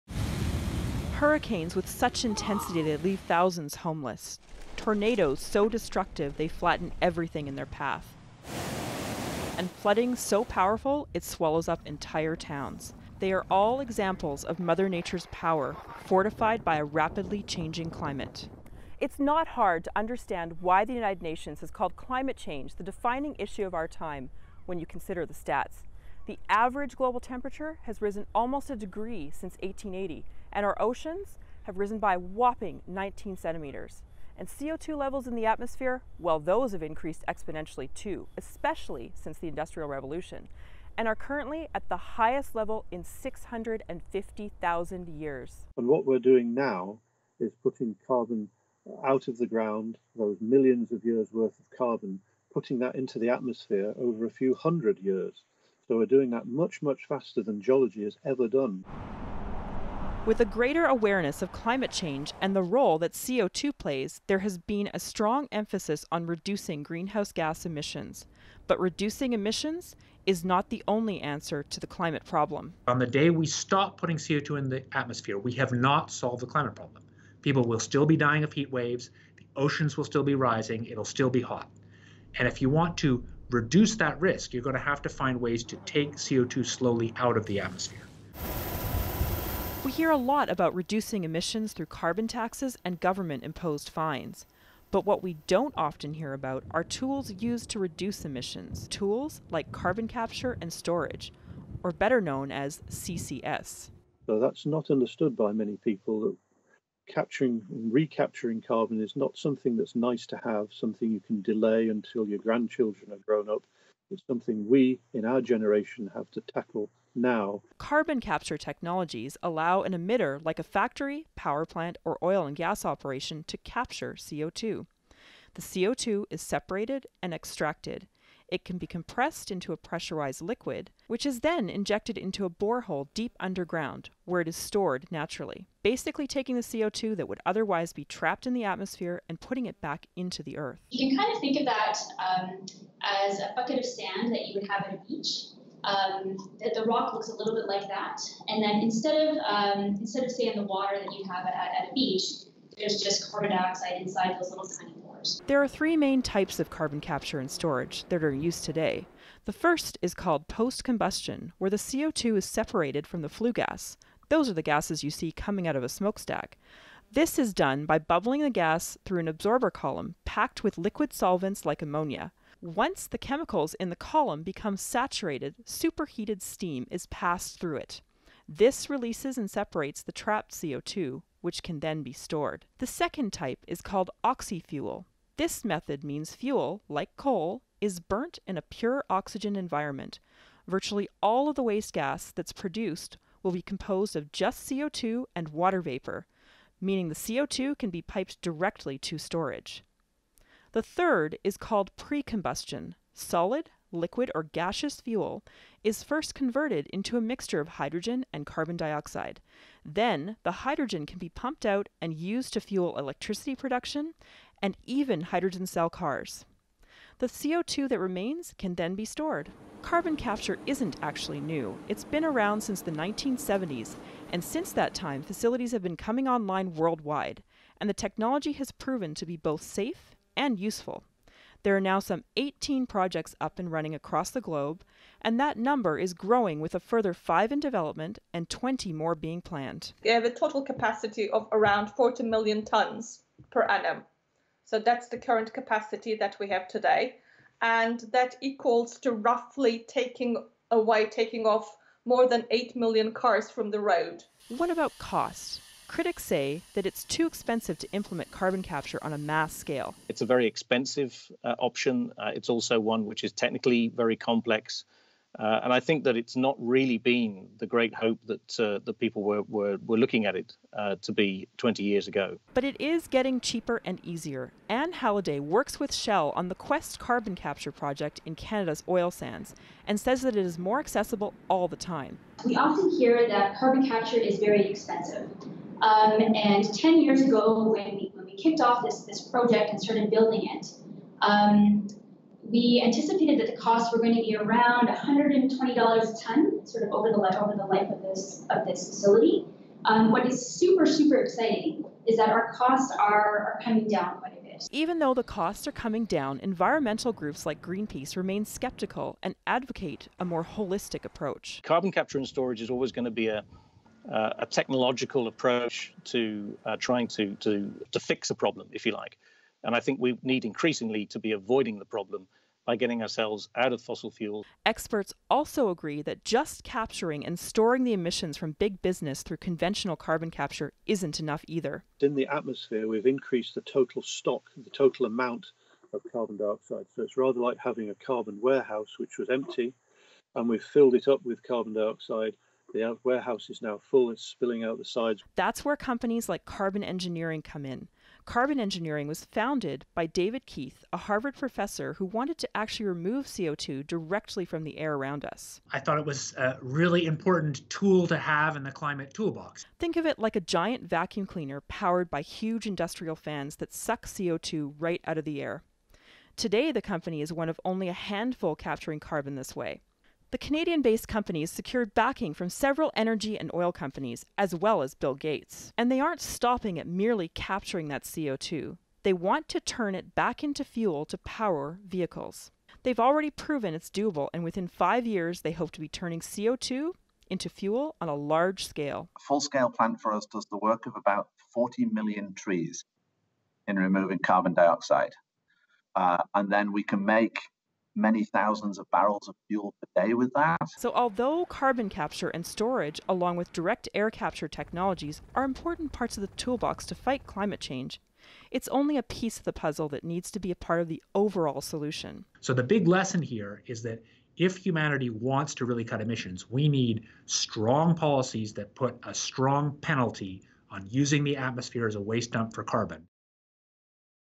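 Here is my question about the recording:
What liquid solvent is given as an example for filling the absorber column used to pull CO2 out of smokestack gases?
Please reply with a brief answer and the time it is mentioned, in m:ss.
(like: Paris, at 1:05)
ammonia, at 2:51.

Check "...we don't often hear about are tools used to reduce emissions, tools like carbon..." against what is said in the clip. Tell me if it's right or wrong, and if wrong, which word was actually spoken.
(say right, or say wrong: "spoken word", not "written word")
right.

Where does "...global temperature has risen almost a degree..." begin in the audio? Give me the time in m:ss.
0:26.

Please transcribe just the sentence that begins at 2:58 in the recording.
This releases and separates the trapped CO2, which can then be stored.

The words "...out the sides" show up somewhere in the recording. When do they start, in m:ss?
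5:44.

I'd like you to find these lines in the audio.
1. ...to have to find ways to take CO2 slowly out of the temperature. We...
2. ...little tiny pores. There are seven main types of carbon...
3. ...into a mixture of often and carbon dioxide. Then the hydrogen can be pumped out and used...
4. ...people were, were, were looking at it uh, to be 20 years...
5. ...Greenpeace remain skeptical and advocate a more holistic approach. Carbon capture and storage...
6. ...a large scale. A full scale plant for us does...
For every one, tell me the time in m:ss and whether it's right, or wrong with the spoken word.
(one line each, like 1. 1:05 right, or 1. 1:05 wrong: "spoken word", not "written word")
1. 1:24 wrong: "atmosphere", not "temperature"
2. 2:34 wrong: "three", not "seven"
3. 3:26 wrong: "hydrogen", not "often"
4. 4:28 right
5. 5:07 right
6. 6:28 right.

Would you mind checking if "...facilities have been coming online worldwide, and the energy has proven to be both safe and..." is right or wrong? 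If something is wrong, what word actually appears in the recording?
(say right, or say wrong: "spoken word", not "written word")
wrong: "technology", not "energy".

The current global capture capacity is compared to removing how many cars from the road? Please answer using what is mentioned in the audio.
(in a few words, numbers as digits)
8 million.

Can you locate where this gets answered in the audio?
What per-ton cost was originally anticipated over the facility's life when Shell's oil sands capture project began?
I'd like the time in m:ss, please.
4:54.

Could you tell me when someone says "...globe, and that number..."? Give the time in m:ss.
3:54.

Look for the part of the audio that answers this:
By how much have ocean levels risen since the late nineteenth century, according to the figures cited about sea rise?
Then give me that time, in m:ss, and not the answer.
0:32.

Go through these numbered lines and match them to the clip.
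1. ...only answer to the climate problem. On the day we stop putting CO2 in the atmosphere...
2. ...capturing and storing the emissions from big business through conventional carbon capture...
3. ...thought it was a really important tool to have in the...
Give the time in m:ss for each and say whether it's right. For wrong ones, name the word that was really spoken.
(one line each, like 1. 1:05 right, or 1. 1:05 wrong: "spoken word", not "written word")
1. 1:10 right
2. 5:26 right
3. 5:55 right.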